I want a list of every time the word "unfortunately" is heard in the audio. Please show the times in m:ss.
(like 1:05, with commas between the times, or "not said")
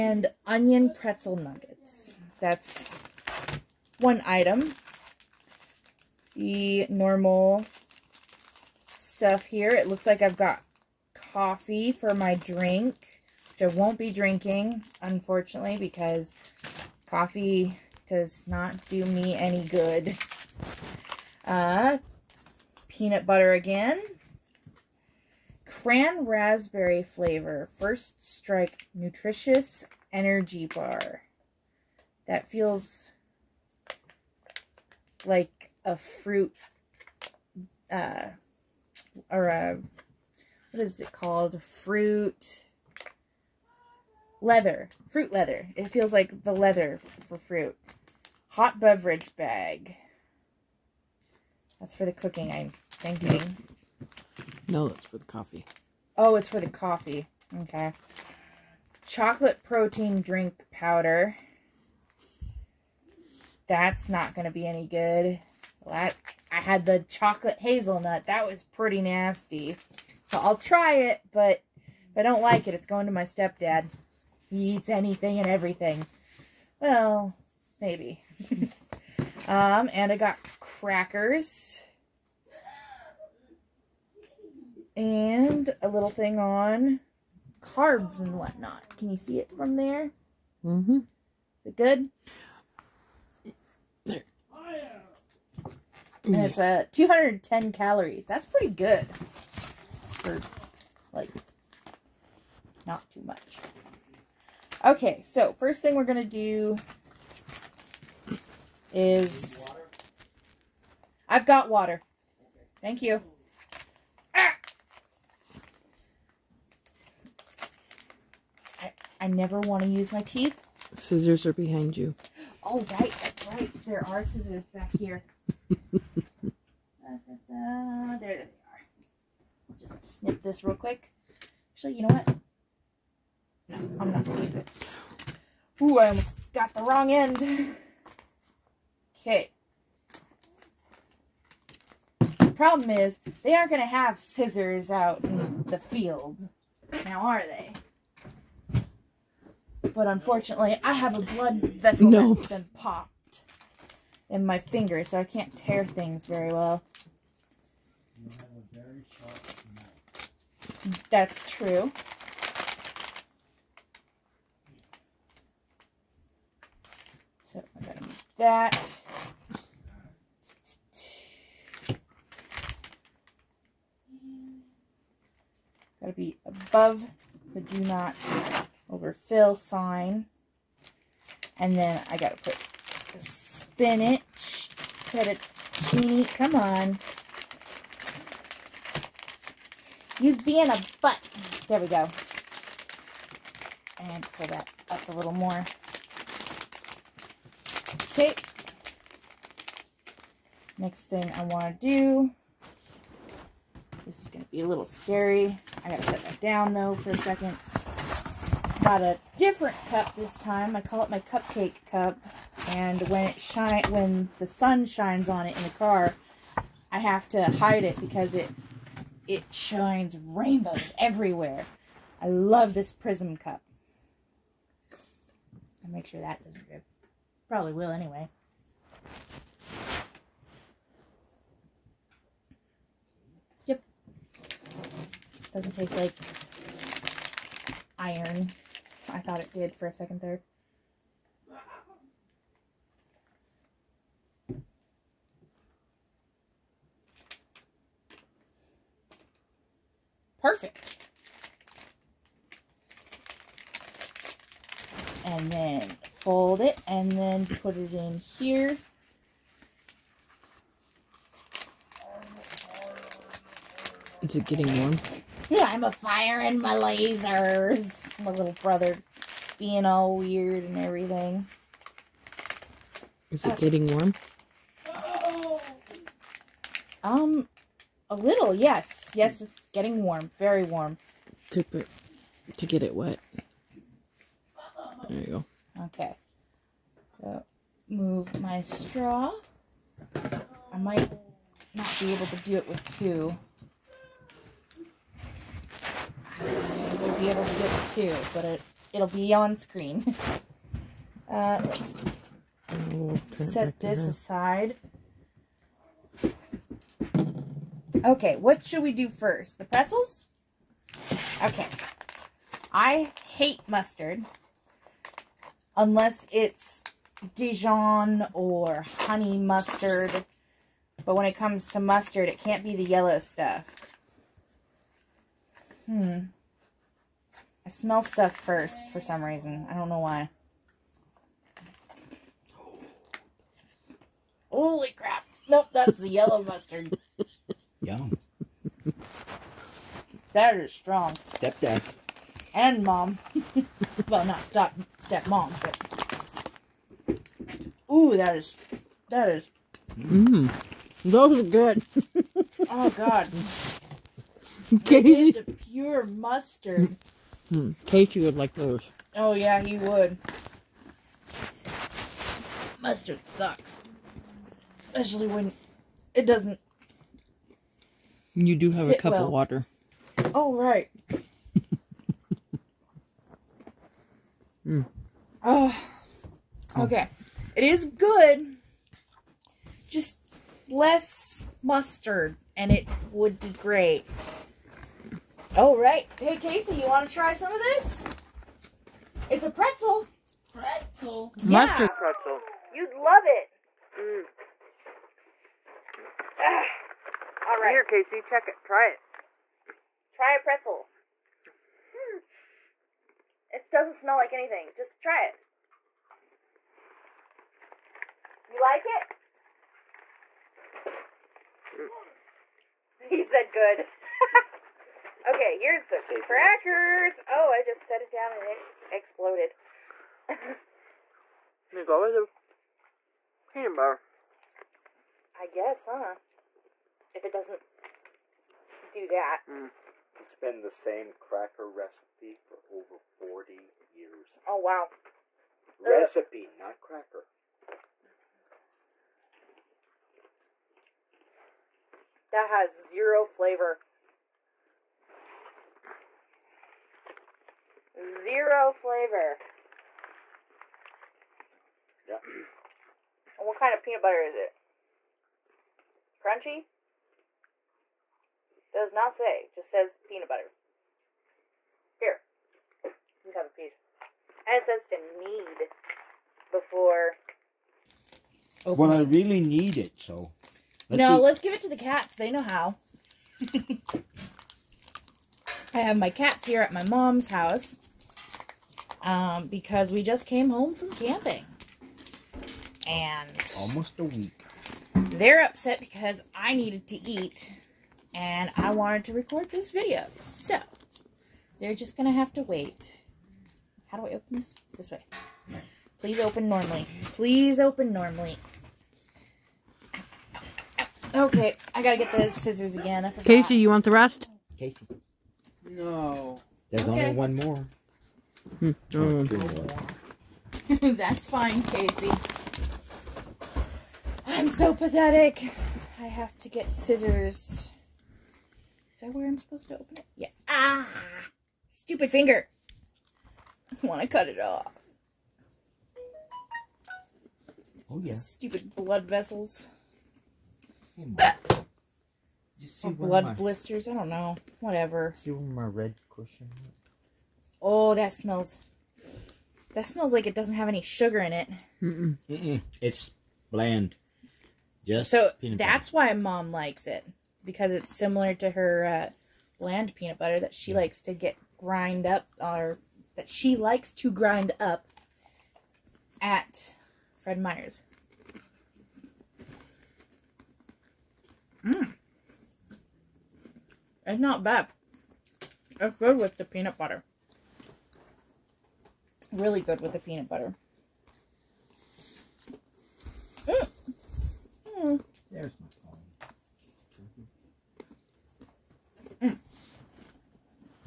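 0:15, 2:30.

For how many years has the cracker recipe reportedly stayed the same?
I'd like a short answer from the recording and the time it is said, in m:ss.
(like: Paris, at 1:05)
Over 40 years, at 7:12.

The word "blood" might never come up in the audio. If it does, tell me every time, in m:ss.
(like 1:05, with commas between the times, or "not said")
2:31, 8:48, 8:52.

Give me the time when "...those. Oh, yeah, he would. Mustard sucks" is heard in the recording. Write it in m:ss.
5:58.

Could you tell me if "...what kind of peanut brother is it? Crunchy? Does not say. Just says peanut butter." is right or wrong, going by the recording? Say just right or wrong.
wrong.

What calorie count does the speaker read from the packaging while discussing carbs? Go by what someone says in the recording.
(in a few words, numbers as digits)
210.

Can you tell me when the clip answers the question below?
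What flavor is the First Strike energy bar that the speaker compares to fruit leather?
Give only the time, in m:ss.
0:25.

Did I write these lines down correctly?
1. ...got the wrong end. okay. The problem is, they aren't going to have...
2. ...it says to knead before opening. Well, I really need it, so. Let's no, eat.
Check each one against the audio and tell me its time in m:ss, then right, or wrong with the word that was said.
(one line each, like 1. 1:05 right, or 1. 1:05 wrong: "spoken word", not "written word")
1. 2:16 right
2. 7:44 right.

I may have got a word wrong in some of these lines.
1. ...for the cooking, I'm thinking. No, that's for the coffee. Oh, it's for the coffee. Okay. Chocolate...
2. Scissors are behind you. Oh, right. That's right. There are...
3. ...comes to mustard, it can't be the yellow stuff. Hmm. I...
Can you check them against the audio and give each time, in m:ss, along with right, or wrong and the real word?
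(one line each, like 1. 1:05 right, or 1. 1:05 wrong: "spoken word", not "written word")
1. 0:51 right
2. 2:00 right
3. 5:21 right.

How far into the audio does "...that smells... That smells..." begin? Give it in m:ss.
8:57.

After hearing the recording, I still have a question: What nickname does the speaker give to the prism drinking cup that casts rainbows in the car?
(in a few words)
Cupcake cup.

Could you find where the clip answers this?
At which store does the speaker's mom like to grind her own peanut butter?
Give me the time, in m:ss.
9:17.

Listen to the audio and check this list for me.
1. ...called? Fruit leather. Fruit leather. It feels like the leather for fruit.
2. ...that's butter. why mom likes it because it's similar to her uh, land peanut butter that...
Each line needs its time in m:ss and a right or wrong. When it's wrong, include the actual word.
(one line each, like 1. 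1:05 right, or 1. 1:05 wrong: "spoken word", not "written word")
1. 0:41 right
2. 9:05 right.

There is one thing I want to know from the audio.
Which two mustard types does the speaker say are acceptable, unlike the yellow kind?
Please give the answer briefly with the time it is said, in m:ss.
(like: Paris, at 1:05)
Dijon or honey mustard, at 5:17.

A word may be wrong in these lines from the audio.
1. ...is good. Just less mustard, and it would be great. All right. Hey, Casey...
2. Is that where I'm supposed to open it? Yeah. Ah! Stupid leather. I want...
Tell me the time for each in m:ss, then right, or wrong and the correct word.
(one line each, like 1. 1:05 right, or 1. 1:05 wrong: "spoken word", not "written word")
1. 6:17 right
2. 8:39 wrong: "finger", not "leather".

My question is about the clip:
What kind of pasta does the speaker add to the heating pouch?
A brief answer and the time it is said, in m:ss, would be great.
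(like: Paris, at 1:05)
Spinach fettuccine, at 3:03.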